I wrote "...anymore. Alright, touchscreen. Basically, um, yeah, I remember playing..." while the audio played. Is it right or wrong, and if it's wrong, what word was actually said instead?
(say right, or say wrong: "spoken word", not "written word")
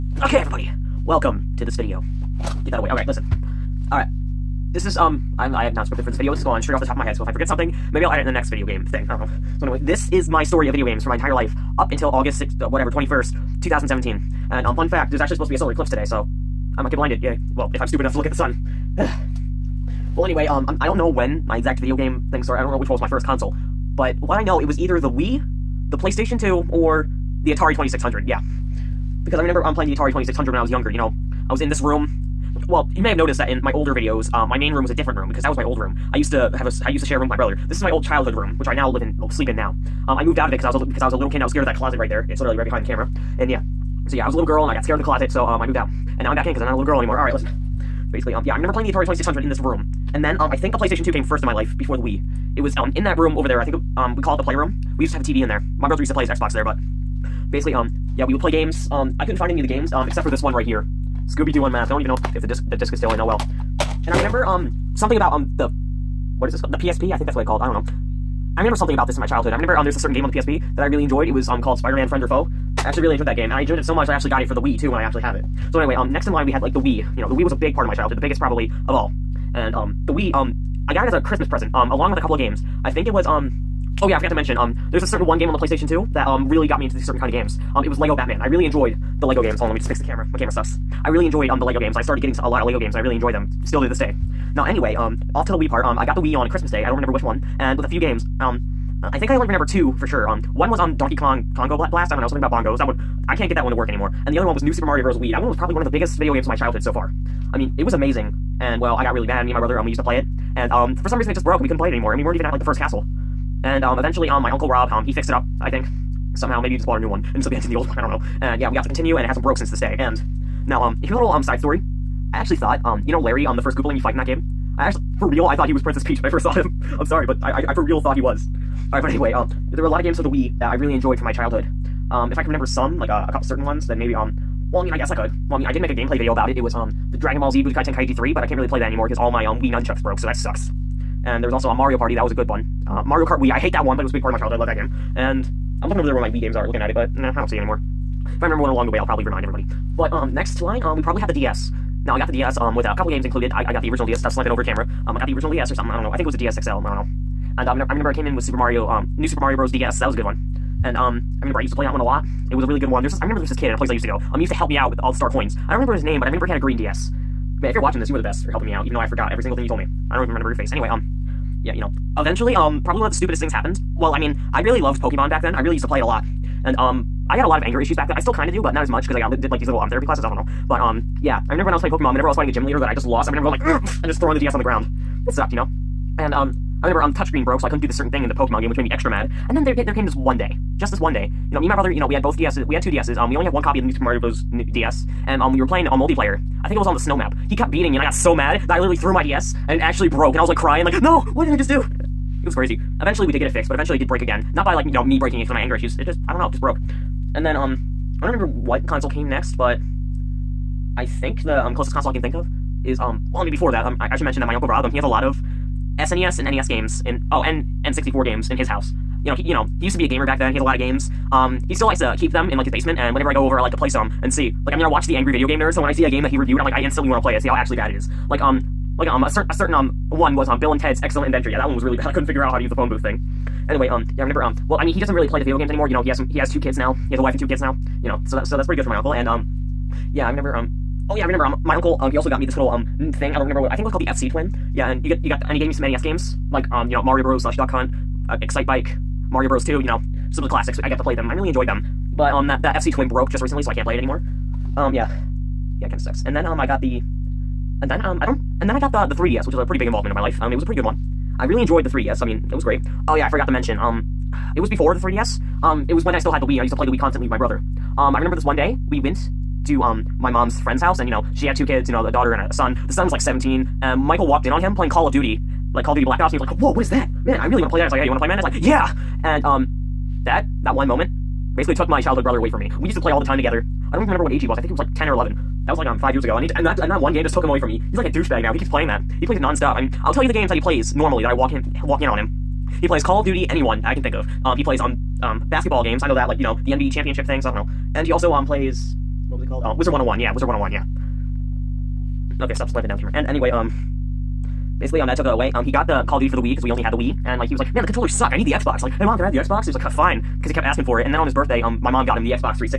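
wrong: "listen", not "touchscreen".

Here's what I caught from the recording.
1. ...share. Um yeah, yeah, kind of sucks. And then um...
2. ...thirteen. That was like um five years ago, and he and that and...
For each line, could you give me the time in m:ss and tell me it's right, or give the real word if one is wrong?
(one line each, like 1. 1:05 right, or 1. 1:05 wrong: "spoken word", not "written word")
1. 4:13 wrong: "anymore", not "share"
2. 4:45 wrong: "eleven", not "thirteen".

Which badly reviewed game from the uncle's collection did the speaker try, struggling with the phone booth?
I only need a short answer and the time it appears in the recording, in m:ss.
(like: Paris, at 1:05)
Bill and Ted's Excellent Adventure, at 3:50.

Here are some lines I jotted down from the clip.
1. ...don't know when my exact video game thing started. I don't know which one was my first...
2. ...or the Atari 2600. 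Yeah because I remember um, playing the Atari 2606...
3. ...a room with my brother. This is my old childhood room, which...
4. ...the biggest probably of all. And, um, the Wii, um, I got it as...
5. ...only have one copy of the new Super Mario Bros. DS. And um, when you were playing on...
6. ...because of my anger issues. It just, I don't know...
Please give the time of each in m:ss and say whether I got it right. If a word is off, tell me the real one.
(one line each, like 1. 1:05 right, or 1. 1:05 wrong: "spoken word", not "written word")
1. 0:20 right
2. 0:26 wrong: "2600", not "2606"
3. 0:37 right
4. 1:18 right
5. 3:13 right
6. 3:25 right.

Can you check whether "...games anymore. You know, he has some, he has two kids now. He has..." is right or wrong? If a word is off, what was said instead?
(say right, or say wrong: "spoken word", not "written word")
right.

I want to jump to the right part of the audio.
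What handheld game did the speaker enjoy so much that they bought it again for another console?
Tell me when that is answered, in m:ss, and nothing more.
1:11.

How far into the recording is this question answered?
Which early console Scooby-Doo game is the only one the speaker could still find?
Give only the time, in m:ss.
1:01.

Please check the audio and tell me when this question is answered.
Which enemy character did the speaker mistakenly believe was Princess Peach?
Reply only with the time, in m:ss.
2:03.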